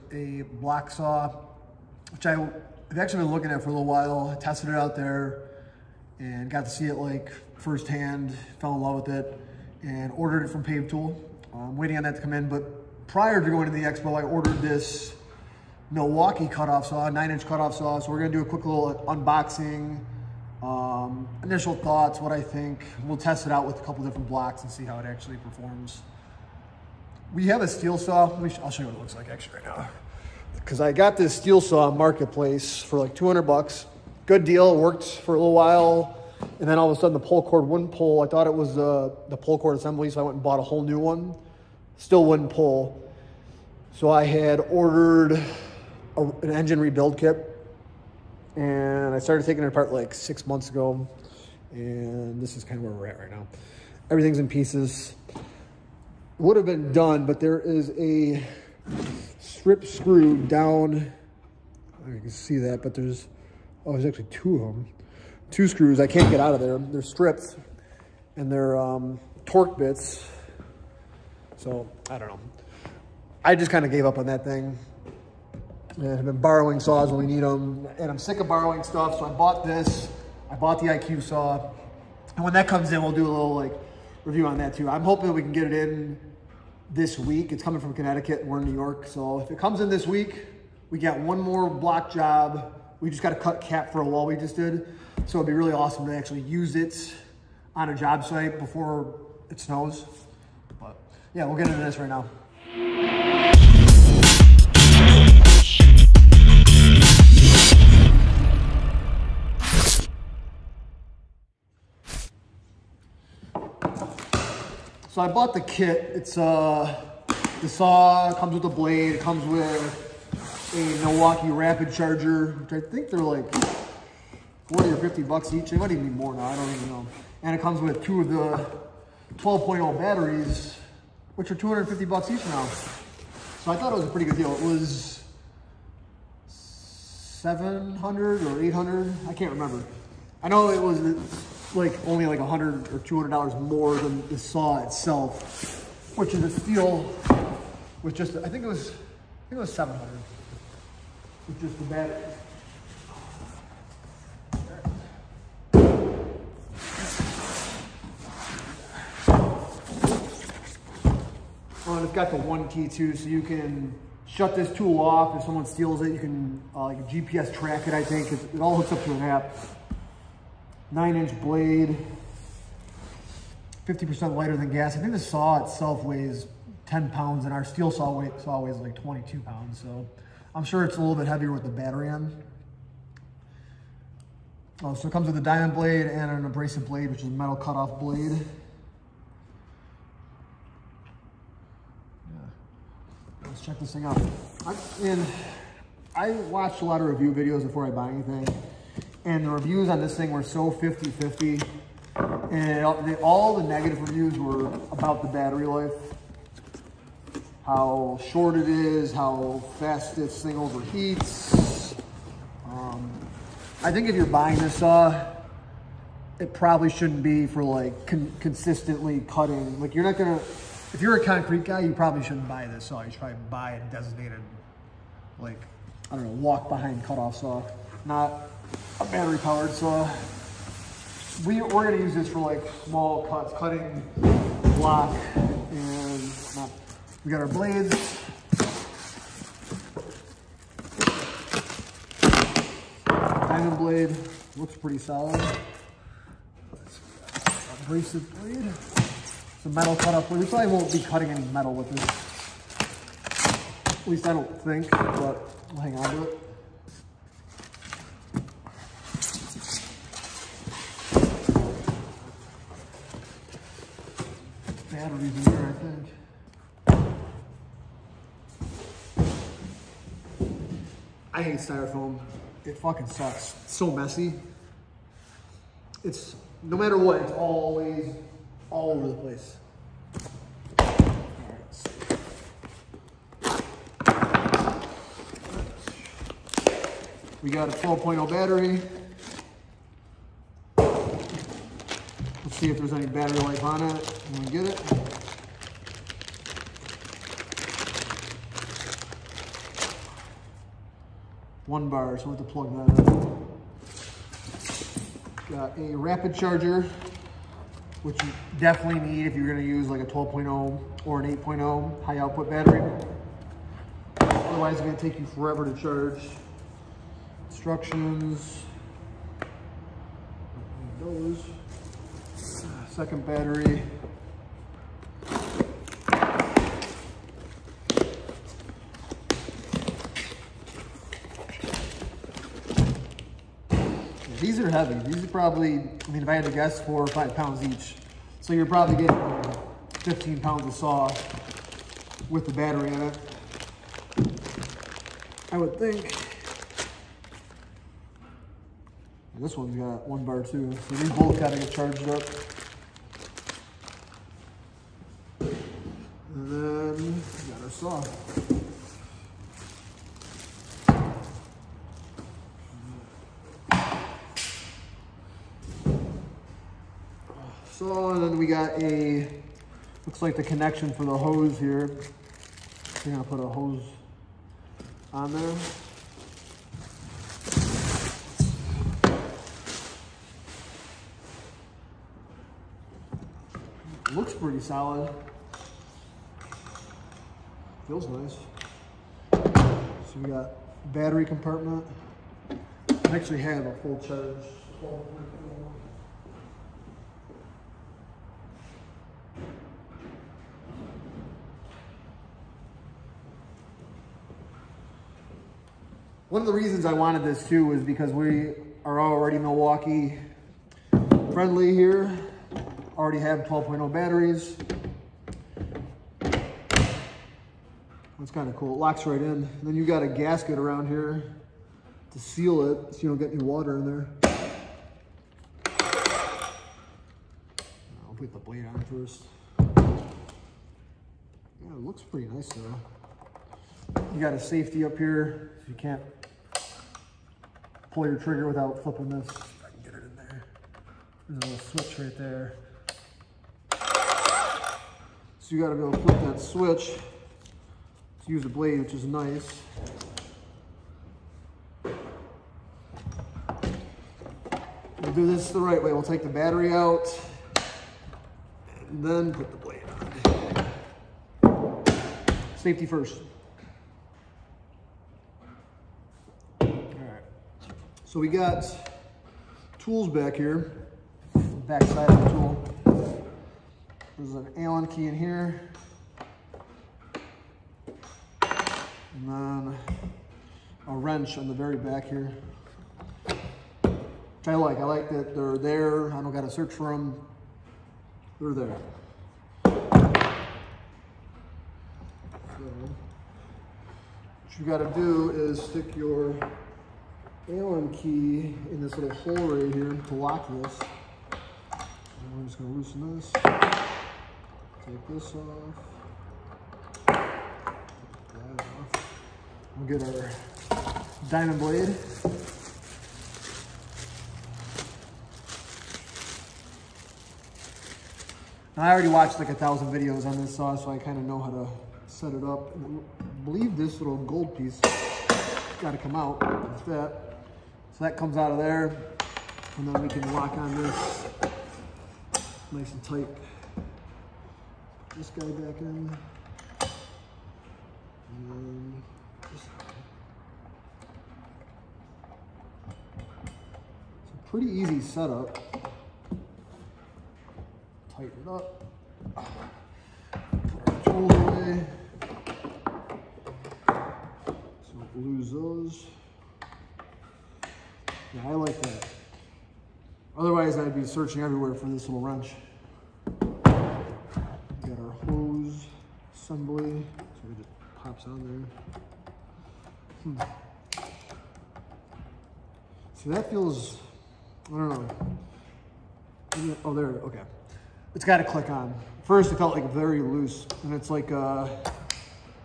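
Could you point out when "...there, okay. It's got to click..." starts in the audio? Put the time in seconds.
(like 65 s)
576 s.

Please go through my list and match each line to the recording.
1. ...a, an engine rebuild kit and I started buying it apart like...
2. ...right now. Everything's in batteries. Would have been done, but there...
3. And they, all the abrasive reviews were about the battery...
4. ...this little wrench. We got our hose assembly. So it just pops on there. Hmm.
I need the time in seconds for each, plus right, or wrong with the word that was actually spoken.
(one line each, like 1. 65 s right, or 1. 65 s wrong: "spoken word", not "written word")
1. 46 s wrong: "taking", not "buying"
2. 53 s wrong: "pieces", not "batteries"
3. 202 s wrong: "negative", not "abrasive"
4. 561 s right.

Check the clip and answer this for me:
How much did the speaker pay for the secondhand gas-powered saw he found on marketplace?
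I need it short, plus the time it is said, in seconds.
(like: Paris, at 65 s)
$200, at 33 s.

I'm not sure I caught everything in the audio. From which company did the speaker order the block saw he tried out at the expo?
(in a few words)
Pave Tool.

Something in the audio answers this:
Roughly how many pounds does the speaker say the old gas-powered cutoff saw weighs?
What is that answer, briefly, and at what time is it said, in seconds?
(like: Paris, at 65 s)
22 pounds, at 179 s.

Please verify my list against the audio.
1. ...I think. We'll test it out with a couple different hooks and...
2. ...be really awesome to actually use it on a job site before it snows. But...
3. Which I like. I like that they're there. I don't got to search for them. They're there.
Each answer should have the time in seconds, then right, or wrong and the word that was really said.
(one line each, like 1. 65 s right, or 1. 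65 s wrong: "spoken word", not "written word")
1. 22 s wrong: "blocks", not "hooks"
2. 95 s right
3. 483 s right.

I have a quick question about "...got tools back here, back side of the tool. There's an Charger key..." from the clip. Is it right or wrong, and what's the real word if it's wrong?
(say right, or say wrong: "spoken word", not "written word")
wrong: "Allen", not "Charger".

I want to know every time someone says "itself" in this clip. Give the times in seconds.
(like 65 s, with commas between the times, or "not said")
144 s, 175 s.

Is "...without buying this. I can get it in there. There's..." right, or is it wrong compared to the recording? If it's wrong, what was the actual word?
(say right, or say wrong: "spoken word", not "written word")
wrong: "flipping", not "buying".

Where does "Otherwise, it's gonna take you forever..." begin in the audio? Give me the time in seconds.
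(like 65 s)
314 s.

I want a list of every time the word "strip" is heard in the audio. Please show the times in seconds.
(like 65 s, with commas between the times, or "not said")
59 s, 67 s.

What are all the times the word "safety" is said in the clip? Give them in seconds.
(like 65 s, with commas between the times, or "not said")
434 s, 462 s.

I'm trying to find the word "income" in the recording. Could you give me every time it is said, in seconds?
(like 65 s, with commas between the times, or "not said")
not said.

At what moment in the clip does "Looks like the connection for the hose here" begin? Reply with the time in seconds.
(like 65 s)
370 s.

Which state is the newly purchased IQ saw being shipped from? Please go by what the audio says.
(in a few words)
Connecticut.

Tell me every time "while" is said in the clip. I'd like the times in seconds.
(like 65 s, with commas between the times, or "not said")
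3 s, 35 s.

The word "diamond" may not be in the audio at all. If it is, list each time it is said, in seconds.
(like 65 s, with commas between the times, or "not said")
185 s, 243 s, 511 s.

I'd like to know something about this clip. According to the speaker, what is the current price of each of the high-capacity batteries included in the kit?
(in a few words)
$250.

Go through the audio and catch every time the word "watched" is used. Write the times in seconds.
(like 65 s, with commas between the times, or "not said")
196 s, 519 s.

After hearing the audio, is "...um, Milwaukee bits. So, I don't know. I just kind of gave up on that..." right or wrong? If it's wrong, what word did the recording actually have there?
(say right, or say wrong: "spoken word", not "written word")
wrong: "Torx", not "Milwaukee".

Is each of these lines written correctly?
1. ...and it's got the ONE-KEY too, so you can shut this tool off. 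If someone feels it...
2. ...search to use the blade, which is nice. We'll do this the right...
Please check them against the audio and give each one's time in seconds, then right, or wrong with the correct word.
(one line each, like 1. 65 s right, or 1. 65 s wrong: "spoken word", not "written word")
1. 161 s wrong: "steals", not "feels"
2. 446 s wrong: "switch", not "search".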